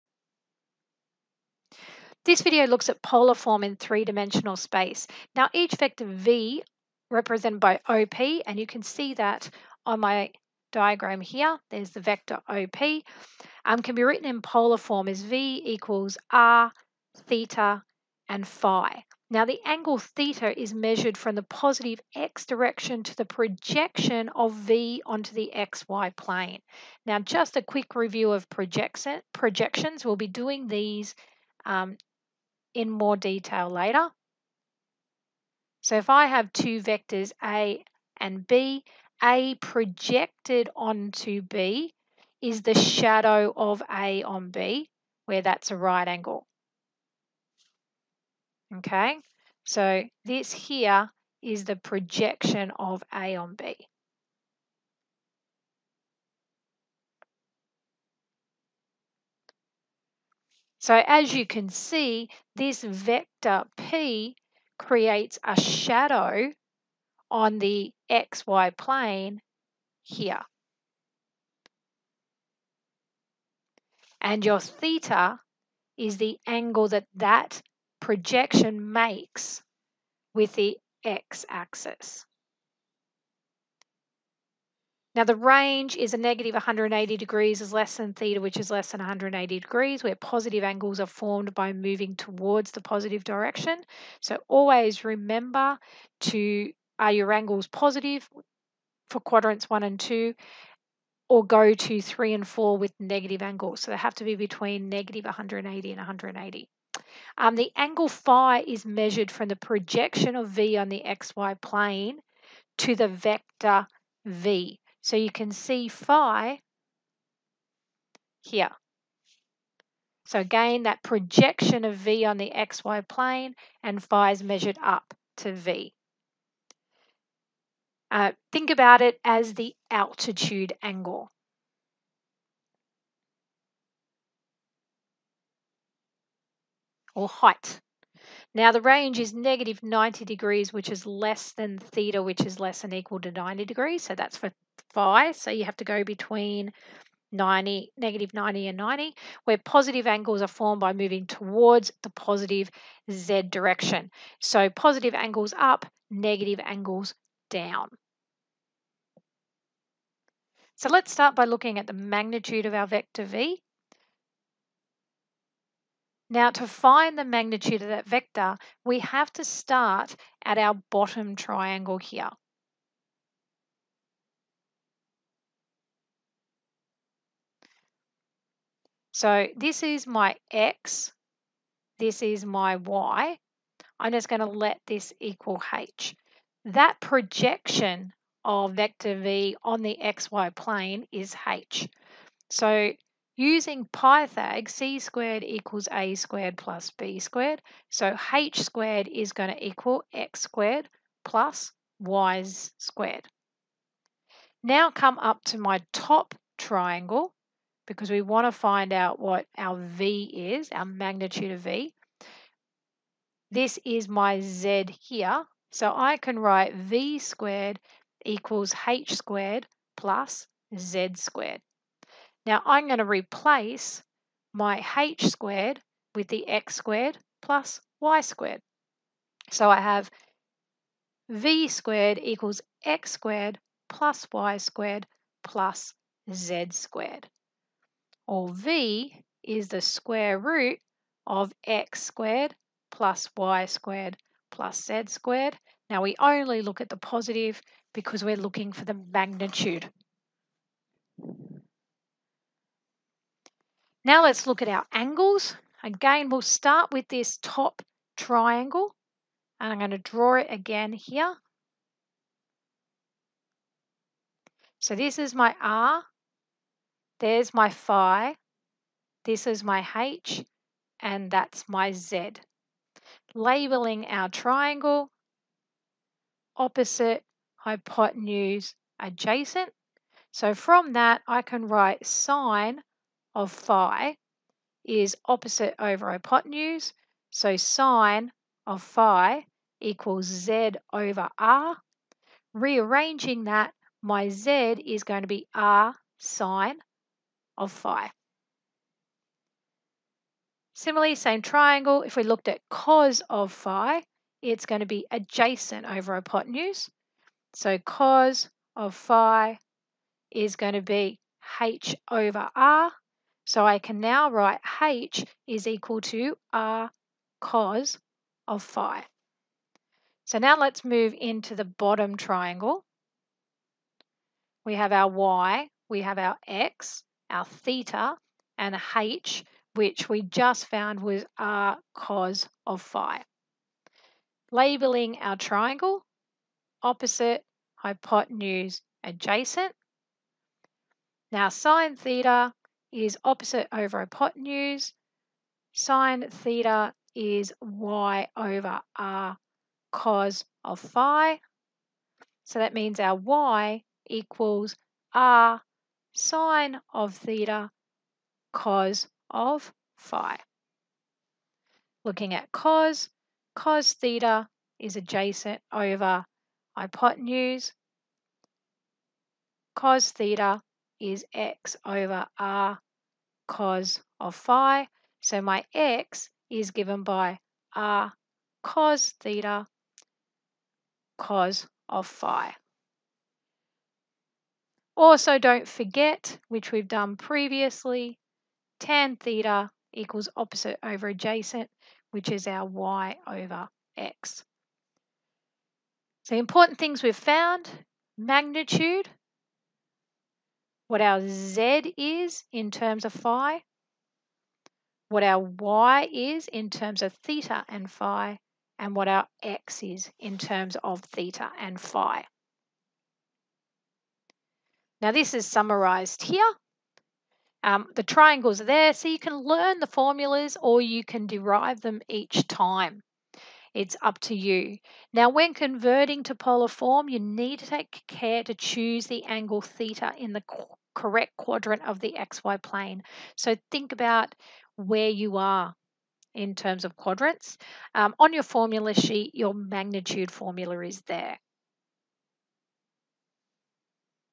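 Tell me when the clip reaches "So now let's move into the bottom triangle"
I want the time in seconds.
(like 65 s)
320 s.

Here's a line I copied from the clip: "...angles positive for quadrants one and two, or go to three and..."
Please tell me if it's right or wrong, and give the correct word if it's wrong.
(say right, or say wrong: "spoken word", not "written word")
right.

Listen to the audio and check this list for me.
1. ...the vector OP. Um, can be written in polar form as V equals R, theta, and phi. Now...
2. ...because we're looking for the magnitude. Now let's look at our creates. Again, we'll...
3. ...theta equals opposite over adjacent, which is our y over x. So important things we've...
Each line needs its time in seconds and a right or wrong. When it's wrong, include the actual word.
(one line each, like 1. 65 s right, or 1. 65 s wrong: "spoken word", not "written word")
1. 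11 s right
2. 247 s wrong: "angles", not "creates"
3. 389 s right.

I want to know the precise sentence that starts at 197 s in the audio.
So H squared is going to equal X squared plus Y squared.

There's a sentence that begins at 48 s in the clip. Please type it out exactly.
Okay, so this here is the projection of A on B.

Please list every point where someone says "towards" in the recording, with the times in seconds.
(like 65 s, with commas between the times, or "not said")
92 s, 151 s.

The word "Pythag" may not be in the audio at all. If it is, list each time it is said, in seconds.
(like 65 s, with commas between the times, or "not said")
193 s.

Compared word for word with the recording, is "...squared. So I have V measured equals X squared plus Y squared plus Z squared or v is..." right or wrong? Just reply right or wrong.
wrong.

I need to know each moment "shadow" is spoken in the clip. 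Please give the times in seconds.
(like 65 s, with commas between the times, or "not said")
42 s, 65 s.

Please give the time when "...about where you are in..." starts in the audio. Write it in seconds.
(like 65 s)
433 s.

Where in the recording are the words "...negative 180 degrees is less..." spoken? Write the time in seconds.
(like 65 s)
86 s.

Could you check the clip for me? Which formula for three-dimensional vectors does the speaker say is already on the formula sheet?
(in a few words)
magnitude formula.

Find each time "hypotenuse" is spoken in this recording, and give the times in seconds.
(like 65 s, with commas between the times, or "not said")
277 s, 286 s, 306 s, 337 s, 343 s, 366 s.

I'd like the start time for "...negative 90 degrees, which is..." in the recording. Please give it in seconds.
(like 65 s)
139 s.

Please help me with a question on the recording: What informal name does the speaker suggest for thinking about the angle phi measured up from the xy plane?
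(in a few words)
altitude angle.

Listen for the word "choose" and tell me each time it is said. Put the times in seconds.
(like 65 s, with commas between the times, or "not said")
428 s.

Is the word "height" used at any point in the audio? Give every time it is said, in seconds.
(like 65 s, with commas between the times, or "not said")
137 s.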